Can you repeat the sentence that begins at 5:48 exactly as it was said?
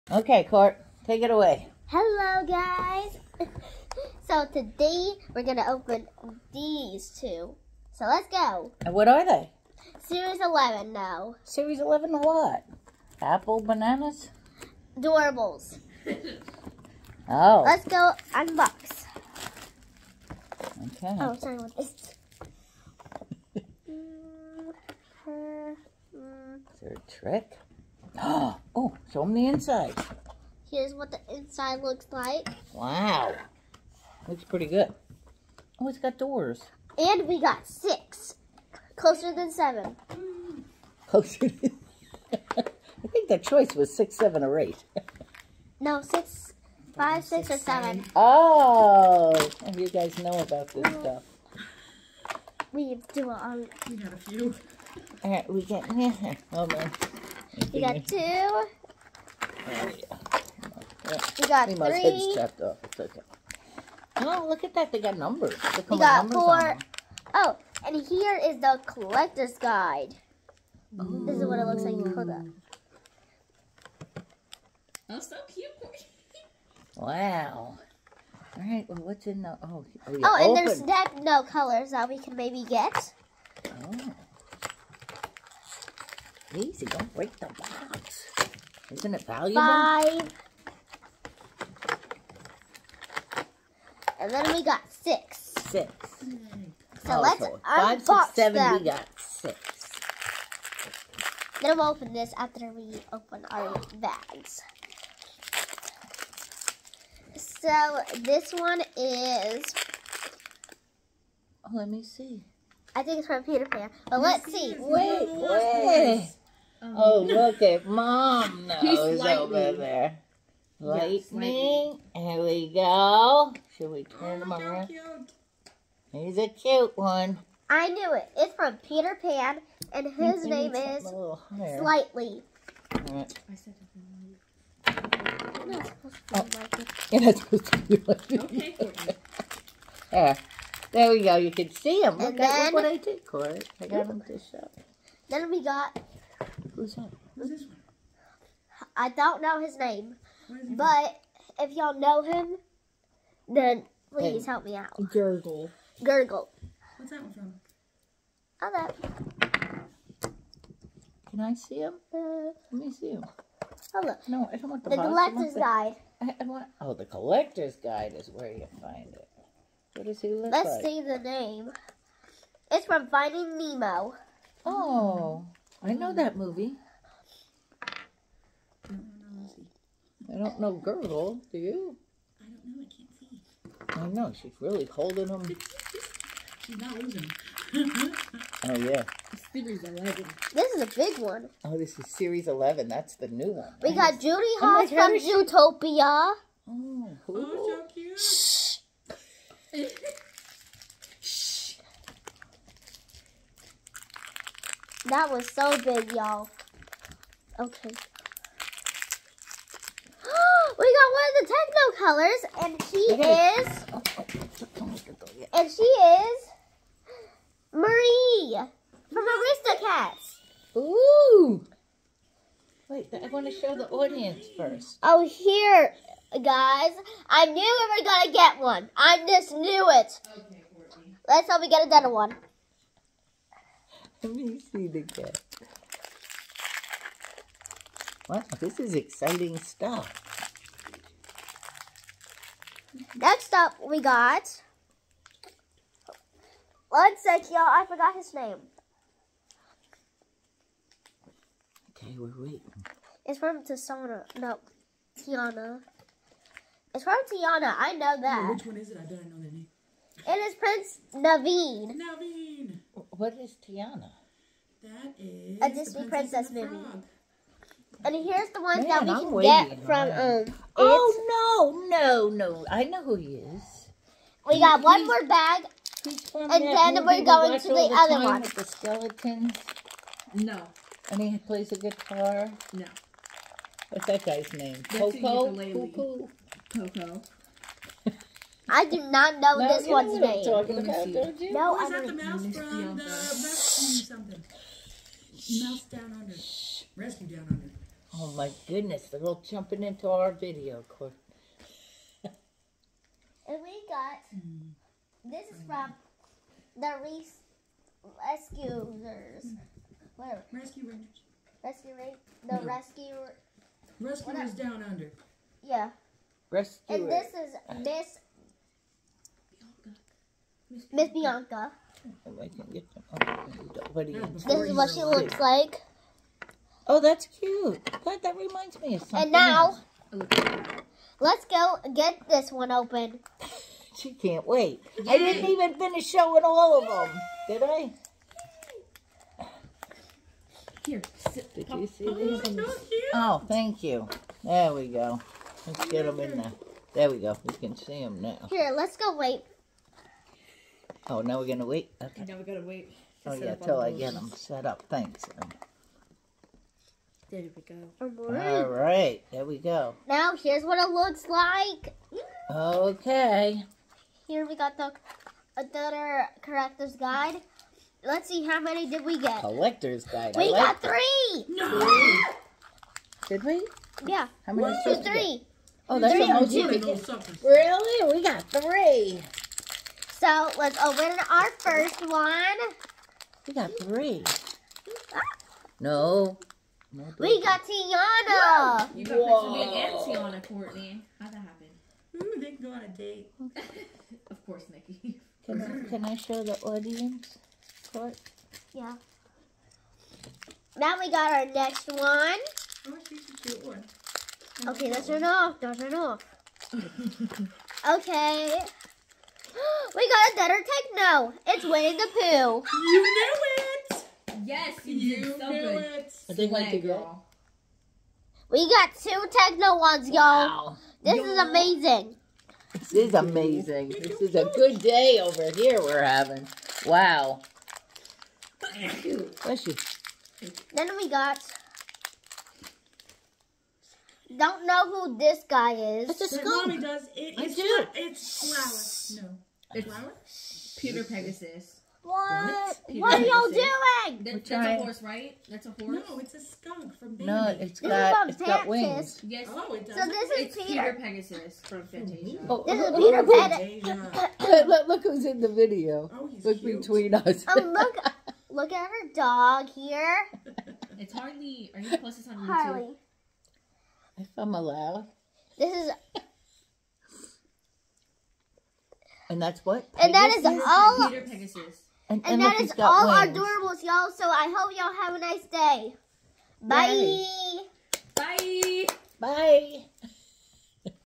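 Here, let's go wait Oh, now we're gonna wait.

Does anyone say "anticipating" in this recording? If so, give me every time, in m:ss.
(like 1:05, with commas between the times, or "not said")
not said.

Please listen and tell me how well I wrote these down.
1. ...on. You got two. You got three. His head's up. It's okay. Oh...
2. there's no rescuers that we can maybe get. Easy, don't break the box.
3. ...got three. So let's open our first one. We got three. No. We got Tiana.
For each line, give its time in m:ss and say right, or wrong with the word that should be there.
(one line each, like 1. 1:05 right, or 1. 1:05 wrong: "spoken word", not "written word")
1. 0:56 right
2. 1:20 wrong: "colors", not "rescuers"
3. 6:18 right.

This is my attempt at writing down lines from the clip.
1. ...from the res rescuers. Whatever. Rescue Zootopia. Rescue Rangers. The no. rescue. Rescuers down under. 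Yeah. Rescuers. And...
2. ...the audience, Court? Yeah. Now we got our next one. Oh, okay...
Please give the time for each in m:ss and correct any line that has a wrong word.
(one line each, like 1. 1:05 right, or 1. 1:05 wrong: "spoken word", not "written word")
1. 5:05 wrong: "Rangers", not "Zootopia"
2. 6:36 right.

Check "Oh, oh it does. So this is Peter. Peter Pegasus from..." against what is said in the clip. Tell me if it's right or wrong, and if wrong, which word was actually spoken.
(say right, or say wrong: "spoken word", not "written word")
right.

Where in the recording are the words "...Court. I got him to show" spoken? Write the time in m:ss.
2:23.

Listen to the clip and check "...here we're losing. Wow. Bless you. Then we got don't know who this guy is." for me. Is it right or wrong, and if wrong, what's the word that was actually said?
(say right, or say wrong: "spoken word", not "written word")
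wrong: "having", not "losing".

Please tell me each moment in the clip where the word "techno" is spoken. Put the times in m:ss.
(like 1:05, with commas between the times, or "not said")
3:32, 6:50, 6:59.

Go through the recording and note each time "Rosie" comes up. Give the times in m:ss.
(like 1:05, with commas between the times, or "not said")
3:00.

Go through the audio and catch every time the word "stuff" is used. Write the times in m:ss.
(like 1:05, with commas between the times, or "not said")
0:50, 3:59.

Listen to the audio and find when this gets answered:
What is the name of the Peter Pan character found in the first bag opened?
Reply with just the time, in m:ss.
2:10.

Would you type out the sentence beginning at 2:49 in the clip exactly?
What does he look Let's like?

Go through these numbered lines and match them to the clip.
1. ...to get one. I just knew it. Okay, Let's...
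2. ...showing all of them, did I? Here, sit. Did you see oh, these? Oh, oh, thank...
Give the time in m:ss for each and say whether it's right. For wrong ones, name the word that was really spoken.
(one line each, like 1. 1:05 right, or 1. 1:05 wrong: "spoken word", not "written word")
1. 3:48 right
2. 5:36 right.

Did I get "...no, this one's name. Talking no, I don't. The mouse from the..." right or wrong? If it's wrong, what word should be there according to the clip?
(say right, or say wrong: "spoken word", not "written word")
right.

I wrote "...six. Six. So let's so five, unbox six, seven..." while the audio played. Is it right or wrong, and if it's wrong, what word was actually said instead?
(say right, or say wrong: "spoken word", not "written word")
right.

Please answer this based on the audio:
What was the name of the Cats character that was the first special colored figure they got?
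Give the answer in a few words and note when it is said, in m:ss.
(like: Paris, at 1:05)
Marie, at 3:37.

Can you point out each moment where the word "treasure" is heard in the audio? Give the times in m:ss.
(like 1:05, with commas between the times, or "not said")
not said.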